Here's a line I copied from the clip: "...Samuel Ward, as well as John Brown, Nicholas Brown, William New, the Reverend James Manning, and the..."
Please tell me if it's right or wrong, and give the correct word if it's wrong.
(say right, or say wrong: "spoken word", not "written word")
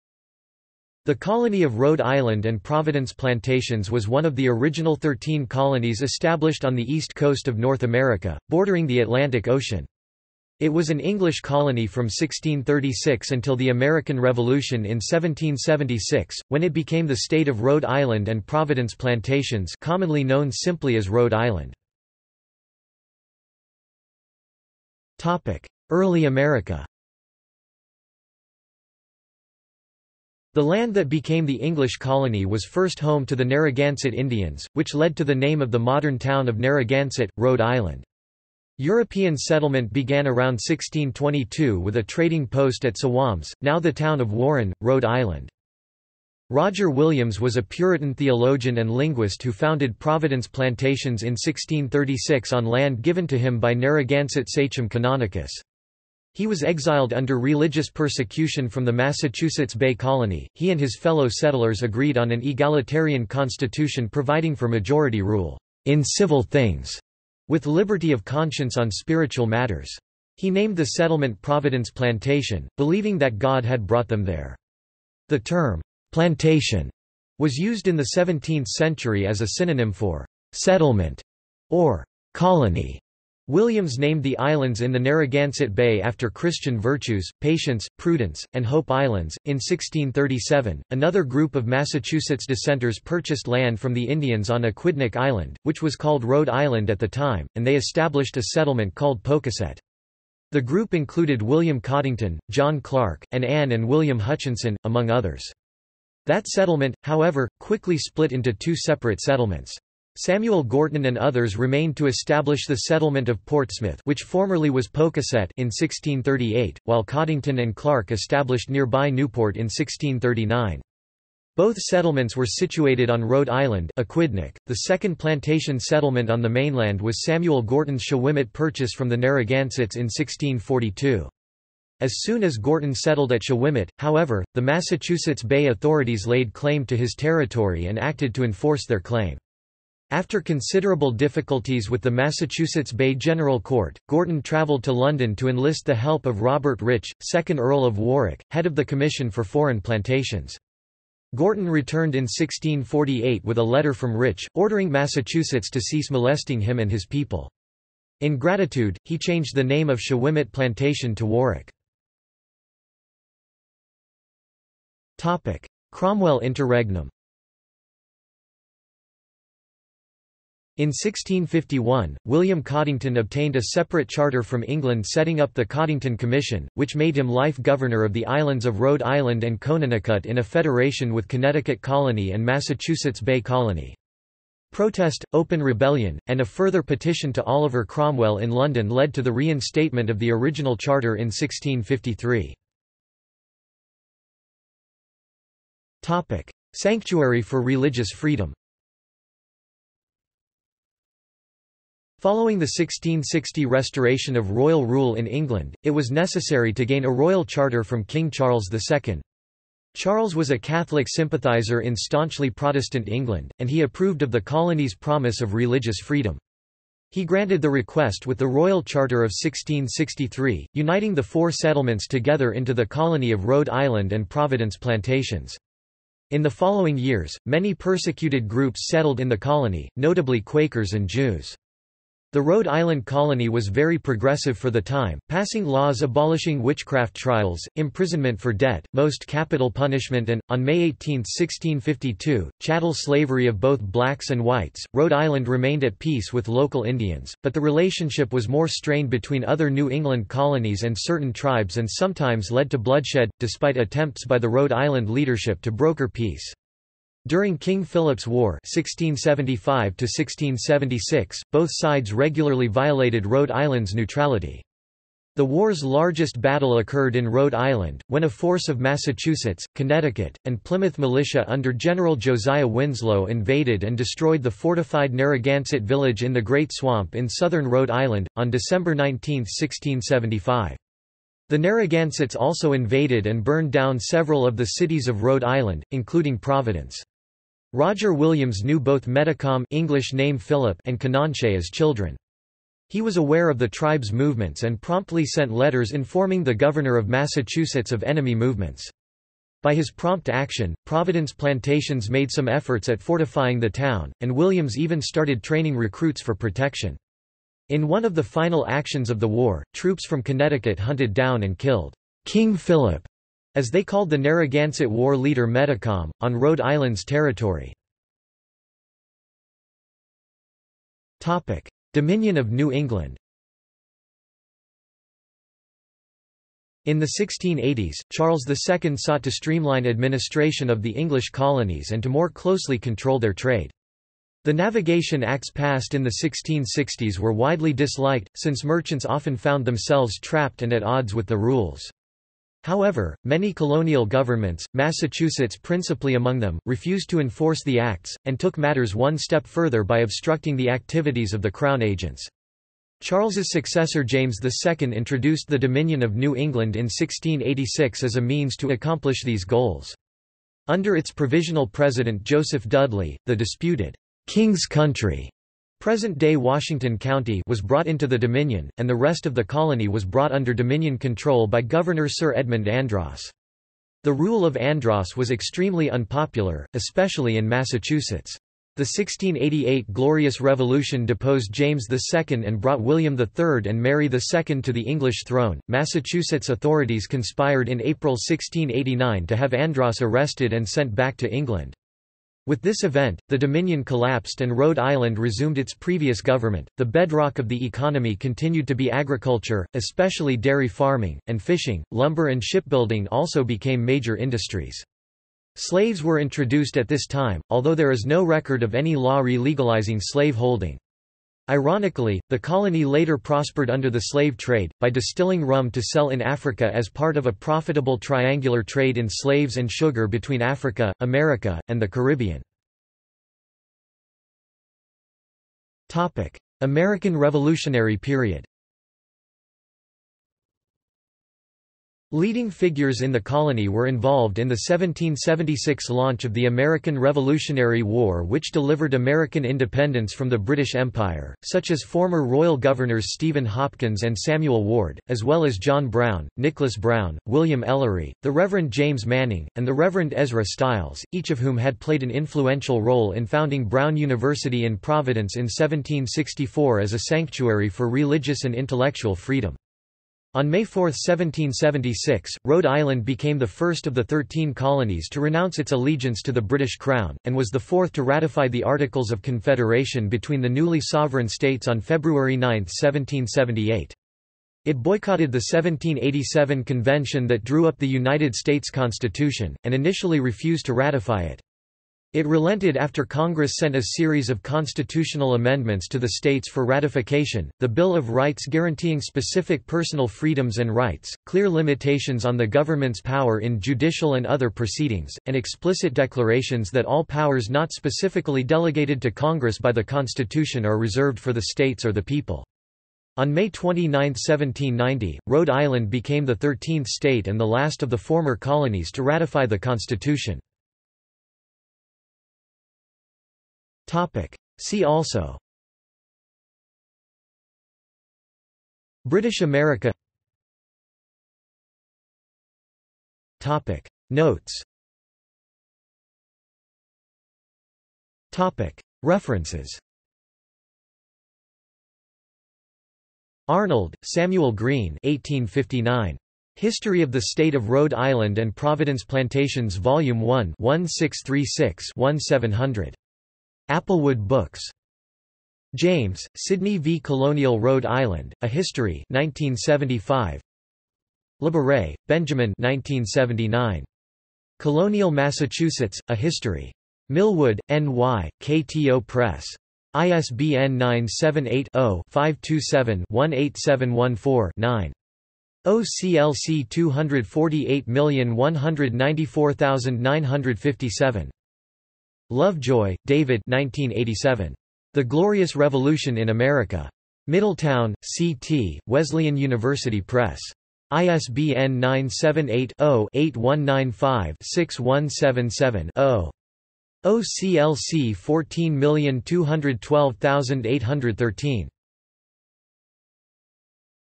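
wrong: "Ellery", not "New".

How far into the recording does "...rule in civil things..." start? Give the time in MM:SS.
01:05.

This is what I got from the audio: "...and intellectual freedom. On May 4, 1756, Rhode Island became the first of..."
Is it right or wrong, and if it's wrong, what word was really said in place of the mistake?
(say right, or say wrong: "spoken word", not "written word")
wrong: "1776", not "1756".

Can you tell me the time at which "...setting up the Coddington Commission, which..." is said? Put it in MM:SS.
02:55.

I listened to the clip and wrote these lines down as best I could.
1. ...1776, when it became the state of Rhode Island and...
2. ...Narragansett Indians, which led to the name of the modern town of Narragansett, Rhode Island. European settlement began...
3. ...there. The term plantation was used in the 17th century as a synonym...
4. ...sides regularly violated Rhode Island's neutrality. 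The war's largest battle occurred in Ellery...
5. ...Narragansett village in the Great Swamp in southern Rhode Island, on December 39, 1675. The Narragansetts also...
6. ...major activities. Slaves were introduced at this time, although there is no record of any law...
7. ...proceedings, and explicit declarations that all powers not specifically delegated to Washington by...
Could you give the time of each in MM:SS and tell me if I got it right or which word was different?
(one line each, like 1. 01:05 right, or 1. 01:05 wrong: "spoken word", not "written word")
1. 00:14 right
2. 00:33 right
3. 01:14 right
4. 04:21 wrong: "Rhode", not "Ellery"
5. 04:35 wrong: "19", not "39"
6. 06:43 wrong: "industries", not "activities"
7. 08:14 wrong: "Congress", not "Washington".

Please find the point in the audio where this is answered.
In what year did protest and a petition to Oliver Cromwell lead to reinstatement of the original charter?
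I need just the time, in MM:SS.
03:11.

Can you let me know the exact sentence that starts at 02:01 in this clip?
Both settlements were situated on Rhode Island Aquidneck.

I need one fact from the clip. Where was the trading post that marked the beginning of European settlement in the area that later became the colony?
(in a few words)
Sowams.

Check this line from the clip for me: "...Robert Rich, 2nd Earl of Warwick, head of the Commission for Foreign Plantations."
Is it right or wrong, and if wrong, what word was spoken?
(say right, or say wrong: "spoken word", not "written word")
right.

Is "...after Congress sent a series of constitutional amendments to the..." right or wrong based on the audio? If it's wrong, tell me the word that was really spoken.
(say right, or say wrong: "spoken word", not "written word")
right.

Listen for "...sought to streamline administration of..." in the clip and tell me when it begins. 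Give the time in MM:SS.
05:28.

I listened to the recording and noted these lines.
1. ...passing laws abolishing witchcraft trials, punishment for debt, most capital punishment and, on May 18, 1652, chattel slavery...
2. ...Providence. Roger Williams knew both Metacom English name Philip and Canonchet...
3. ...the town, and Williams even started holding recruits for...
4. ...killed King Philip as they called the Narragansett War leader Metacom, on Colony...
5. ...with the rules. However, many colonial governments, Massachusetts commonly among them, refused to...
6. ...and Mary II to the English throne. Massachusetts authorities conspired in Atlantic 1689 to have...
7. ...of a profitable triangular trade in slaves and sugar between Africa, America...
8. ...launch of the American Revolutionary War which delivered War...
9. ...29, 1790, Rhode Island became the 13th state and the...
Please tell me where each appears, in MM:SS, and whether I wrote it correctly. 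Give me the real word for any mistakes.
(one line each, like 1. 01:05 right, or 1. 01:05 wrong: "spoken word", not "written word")
1. 03:55 wrong: "imprisonment", not "punishment"
2. 04:46 right
3. 05:03 wrong: "training", not "holding"
4. 05:11 wrong: "Rhode", not "Colony"
5. 05:41 wrong: "principally", not "commonly"
6. 06:23 wrong: "April", not "Atlantic"
7. 06:57 right
8. 07:15 wrong: "American", not "War"
9. 08:23 right.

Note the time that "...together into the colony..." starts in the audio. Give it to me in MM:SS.
03:42.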